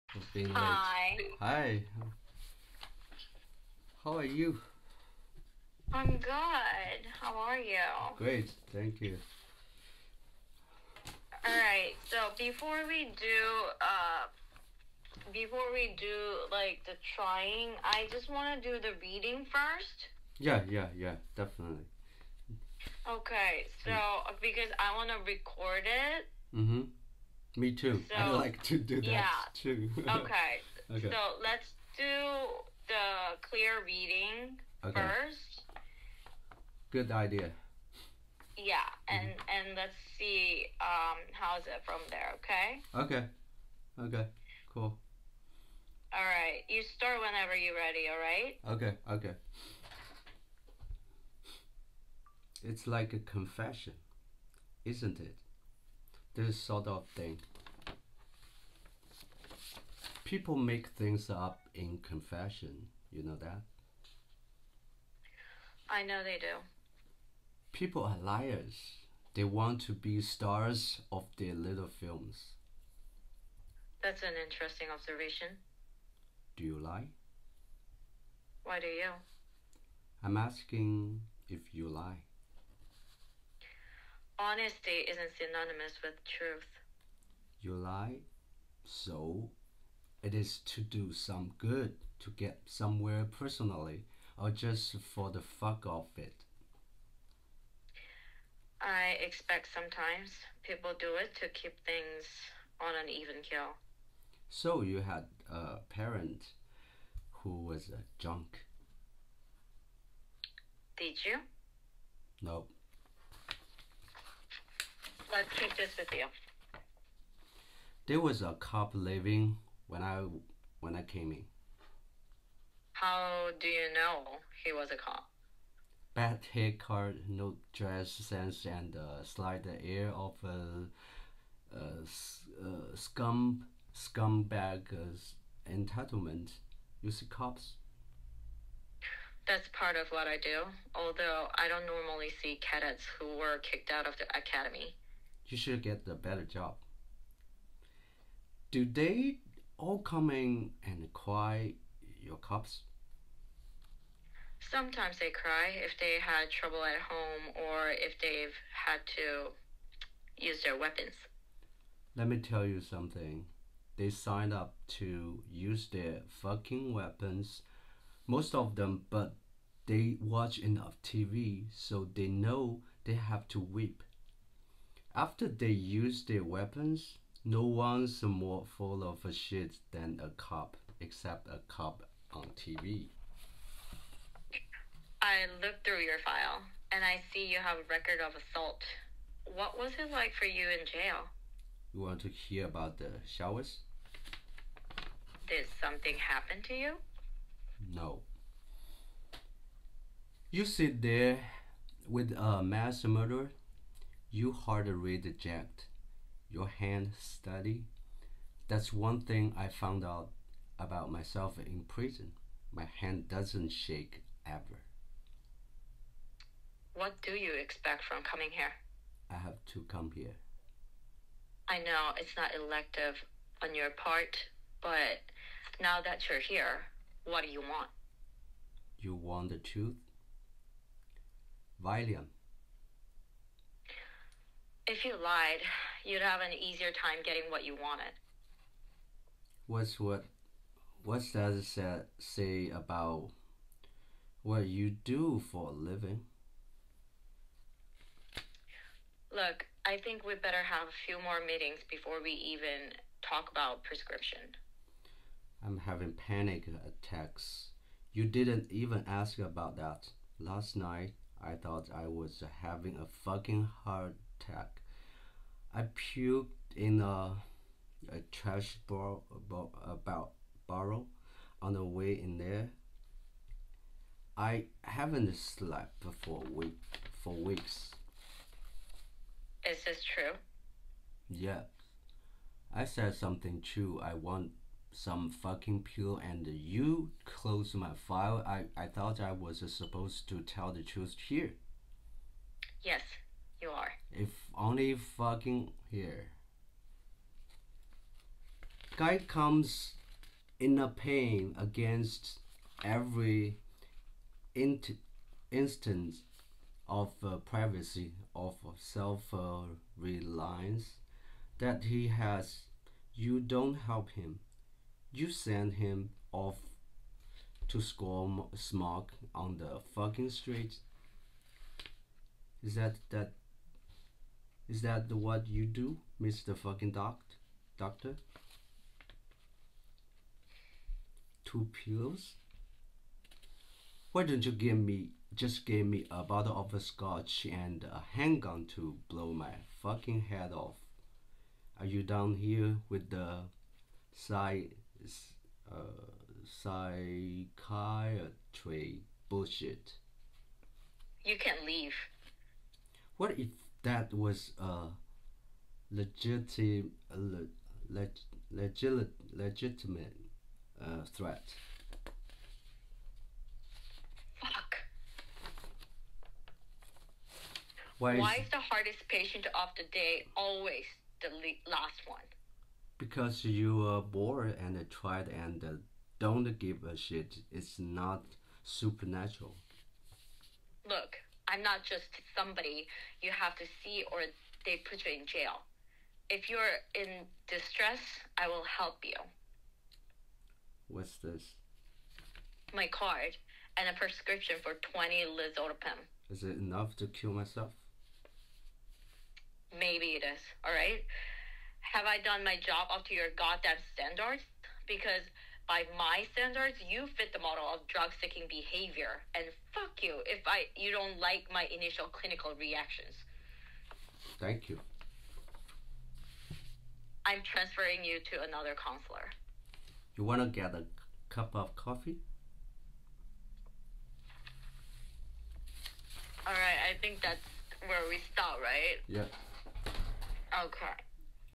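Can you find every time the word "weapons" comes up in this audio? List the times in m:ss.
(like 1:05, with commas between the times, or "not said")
2:40, 2:46, 2:56.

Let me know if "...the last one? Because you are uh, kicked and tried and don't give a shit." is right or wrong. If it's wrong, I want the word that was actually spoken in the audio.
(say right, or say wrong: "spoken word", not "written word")
wrong: "bored", not "kicked".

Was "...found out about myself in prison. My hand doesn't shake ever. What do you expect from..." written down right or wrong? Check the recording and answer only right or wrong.
right.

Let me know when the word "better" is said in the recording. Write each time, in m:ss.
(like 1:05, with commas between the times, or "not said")
2:26, 4:10.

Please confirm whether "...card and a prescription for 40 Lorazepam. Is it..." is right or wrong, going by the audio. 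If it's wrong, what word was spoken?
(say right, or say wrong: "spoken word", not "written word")
wrong: "20", not "40".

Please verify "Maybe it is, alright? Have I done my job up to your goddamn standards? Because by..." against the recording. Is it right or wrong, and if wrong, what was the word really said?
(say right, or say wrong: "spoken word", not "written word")
right.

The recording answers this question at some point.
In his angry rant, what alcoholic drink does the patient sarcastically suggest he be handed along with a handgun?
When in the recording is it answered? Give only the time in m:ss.
5:36.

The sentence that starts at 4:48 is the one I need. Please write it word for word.
I, I thought I was supposed to tell the truth here.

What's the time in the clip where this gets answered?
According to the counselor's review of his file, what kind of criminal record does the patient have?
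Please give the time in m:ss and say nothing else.
3:08.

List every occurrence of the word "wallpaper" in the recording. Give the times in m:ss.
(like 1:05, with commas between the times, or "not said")
not said.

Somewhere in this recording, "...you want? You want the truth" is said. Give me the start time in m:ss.
3:47.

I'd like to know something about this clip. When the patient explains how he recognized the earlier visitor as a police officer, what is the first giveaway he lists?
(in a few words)
Bad haircut.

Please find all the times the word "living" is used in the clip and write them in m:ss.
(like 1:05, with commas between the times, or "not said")
1:58, 4:05.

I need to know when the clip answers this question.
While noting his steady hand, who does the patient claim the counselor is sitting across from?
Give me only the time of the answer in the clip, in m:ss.
3:22.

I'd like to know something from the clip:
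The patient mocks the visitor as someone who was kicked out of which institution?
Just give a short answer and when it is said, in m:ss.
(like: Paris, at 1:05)
The academy, at 2:24.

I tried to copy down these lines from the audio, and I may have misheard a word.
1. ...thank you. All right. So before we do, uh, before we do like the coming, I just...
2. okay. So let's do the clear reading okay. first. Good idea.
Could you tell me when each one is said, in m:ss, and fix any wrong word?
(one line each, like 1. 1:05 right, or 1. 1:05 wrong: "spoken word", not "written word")
1. 0:08 wrong: "trying", not "coming"
2. 0:30 right.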